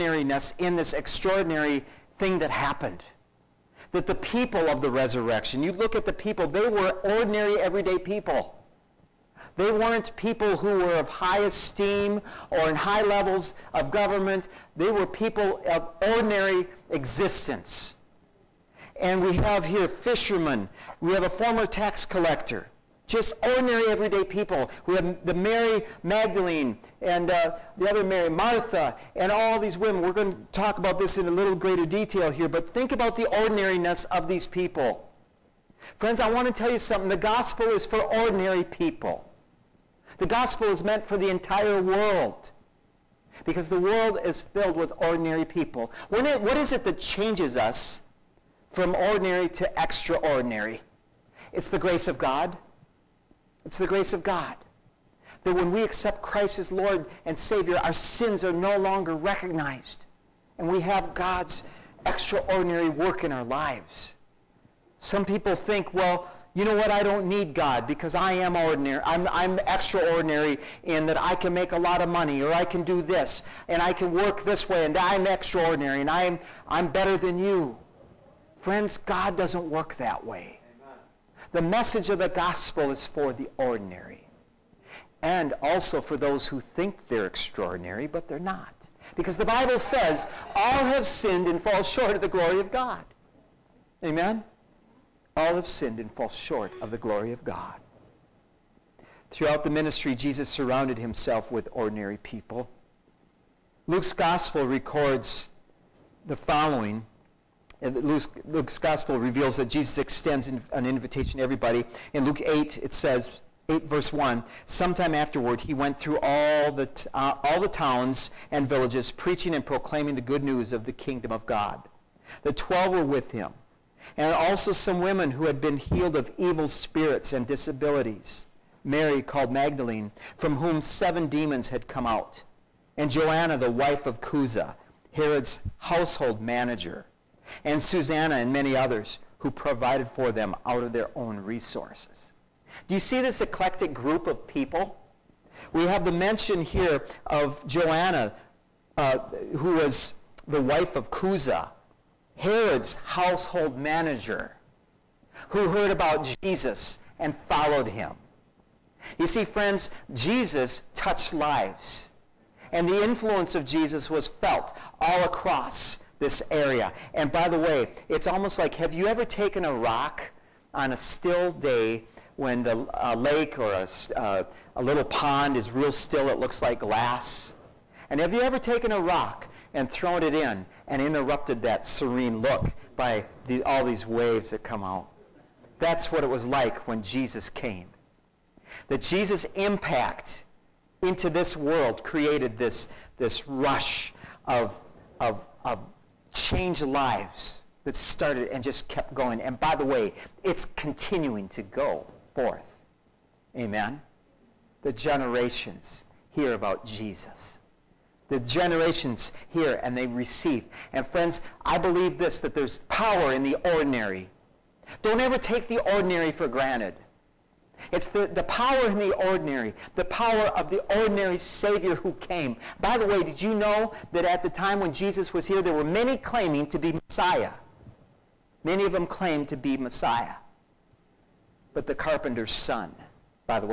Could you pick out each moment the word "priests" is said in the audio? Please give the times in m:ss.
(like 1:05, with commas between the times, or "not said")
not said.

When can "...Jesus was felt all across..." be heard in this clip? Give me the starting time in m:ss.
2:43.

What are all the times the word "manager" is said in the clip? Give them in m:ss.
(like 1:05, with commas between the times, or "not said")
2:16, 2:33.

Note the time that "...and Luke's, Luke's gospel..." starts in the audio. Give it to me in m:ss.
1:47.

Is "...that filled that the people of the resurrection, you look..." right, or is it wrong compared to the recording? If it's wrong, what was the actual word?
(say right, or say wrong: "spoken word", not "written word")
wrong: "happened", not "filled".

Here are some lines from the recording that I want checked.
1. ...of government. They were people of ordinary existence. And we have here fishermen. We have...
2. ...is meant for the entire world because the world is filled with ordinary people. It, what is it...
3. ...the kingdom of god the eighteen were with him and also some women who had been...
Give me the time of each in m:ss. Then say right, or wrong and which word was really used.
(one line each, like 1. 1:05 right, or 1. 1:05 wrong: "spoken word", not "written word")
1. 0:13 right
2. 0:40 right
3. 2:00 wrong: "twelve", not "eighteen".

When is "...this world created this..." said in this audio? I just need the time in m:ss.
3:11.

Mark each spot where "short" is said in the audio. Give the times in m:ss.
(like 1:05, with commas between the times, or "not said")
1:31, 1:36.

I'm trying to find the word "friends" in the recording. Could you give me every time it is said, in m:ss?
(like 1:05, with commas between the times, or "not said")
0:35, 1:18, 2:39, 3:31.